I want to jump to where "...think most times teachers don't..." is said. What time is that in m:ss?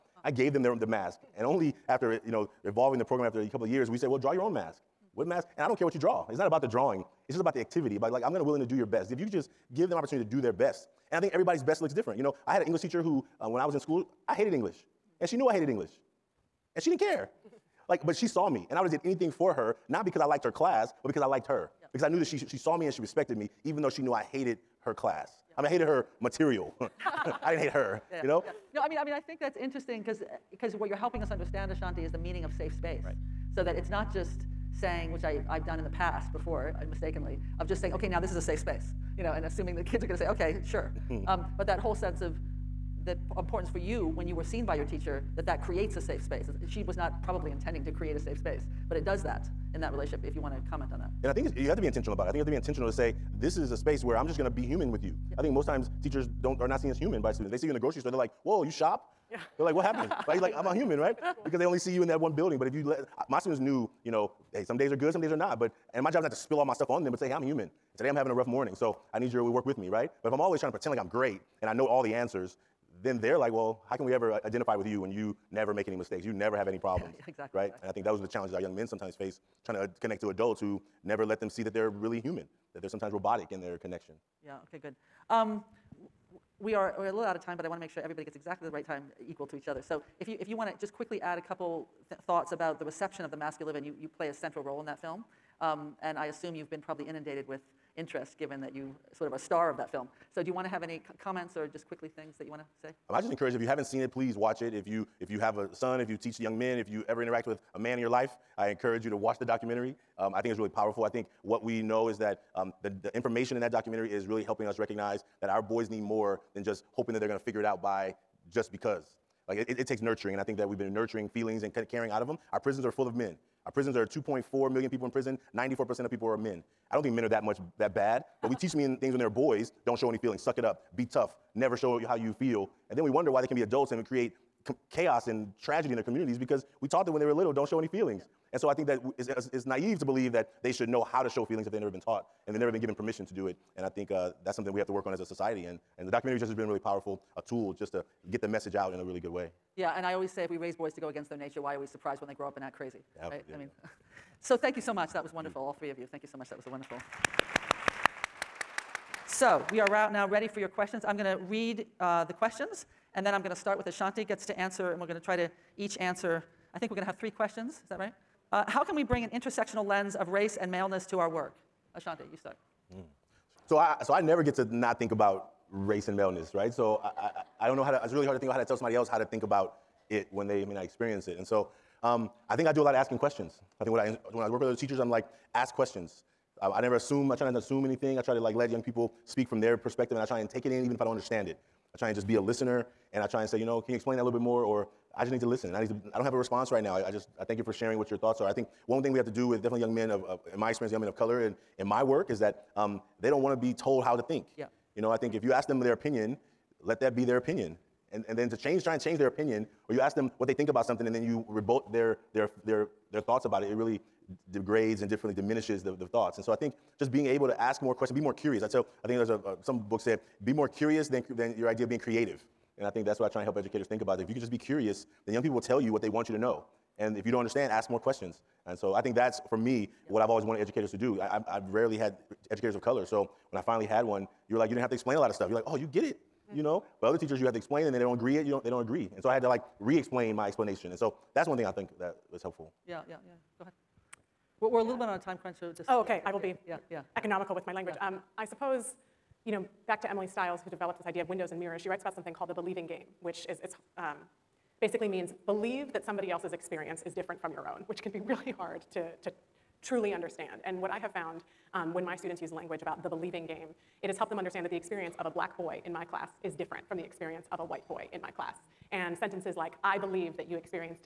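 0:55.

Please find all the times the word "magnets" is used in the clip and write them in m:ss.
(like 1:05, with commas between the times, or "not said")
not said.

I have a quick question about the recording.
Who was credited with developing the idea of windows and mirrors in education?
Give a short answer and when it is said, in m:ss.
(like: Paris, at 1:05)
Emily Stiles, at 4:10.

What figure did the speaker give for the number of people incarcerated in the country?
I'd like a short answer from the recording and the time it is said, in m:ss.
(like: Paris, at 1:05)
2.4 million, at 2:04.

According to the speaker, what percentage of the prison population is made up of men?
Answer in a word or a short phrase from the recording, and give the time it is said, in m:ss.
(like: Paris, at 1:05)
94%, at 2:05.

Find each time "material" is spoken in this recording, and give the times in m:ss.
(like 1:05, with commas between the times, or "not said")
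0:26.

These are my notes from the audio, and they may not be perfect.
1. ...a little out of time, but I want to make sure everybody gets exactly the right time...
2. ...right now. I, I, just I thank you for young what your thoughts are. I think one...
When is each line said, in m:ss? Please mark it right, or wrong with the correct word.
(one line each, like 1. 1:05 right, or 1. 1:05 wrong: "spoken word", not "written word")
1. 1:27 right
2. 3:16 wrong: "sharing", not "young".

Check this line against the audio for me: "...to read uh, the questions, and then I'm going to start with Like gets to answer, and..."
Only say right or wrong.
wrong.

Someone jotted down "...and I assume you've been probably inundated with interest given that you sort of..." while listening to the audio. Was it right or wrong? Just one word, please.
right.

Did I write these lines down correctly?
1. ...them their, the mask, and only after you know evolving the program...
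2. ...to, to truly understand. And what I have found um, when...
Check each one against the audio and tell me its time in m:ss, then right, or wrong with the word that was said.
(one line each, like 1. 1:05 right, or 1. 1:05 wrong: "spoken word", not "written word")
1. 0:00 right
2. 4:18 right.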